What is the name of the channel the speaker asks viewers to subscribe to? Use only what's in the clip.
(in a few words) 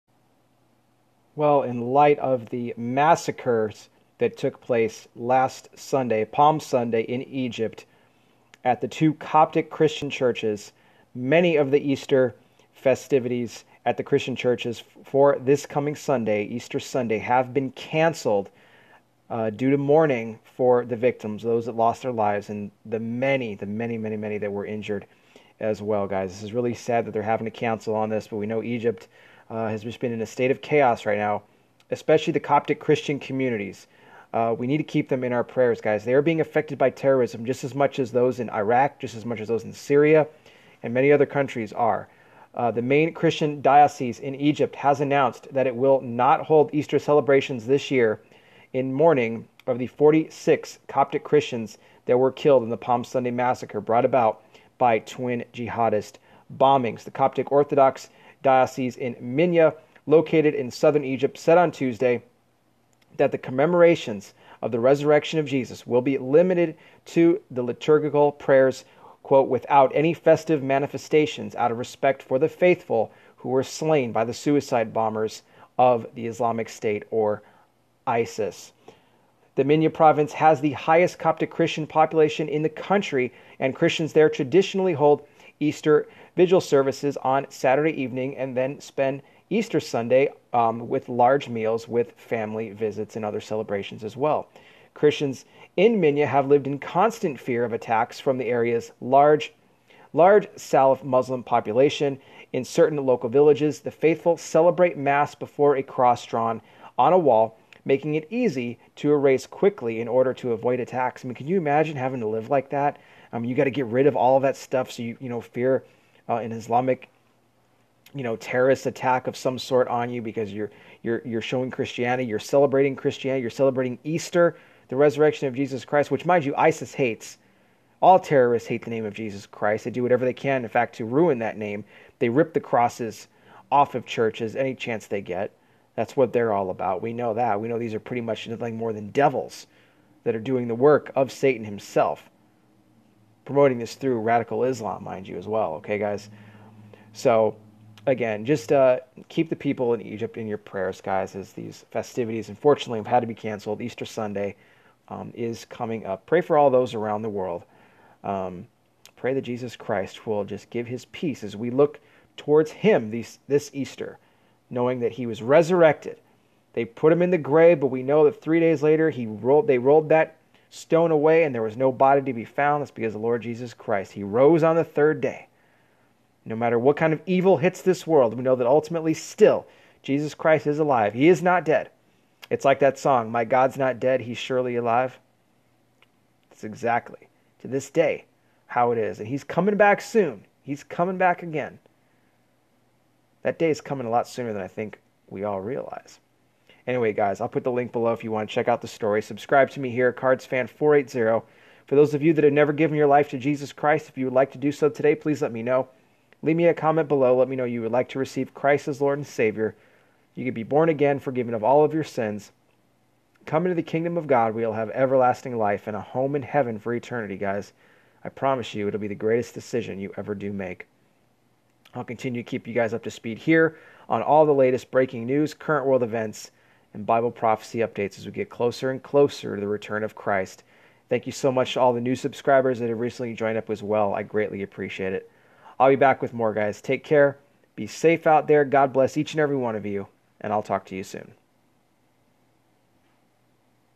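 CardsFan480.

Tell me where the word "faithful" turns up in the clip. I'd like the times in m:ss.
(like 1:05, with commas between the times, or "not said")
1:12, 1:43.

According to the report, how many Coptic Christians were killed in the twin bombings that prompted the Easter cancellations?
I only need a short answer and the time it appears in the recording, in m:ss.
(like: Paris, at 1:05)
46, at 0:49.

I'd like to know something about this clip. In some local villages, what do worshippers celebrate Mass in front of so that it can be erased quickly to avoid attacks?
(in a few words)
A cross drawn on a wall.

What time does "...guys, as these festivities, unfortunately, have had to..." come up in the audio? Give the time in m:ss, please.
2:31.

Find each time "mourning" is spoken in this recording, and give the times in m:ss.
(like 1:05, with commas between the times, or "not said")
0:19, 0:48.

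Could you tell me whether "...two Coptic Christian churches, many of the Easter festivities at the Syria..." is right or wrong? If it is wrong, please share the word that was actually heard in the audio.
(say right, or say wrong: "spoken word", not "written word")
wrong: "Christian", not "Syria".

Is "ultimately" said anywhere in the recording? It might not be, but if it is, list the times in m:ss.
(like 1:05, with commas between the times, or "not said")
2:58.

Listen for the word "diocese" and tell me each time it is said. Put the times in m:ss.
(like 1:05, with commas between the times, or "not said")
0:43, 0:58.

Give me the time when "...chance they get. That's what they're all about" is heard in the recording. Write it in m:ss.
2:14.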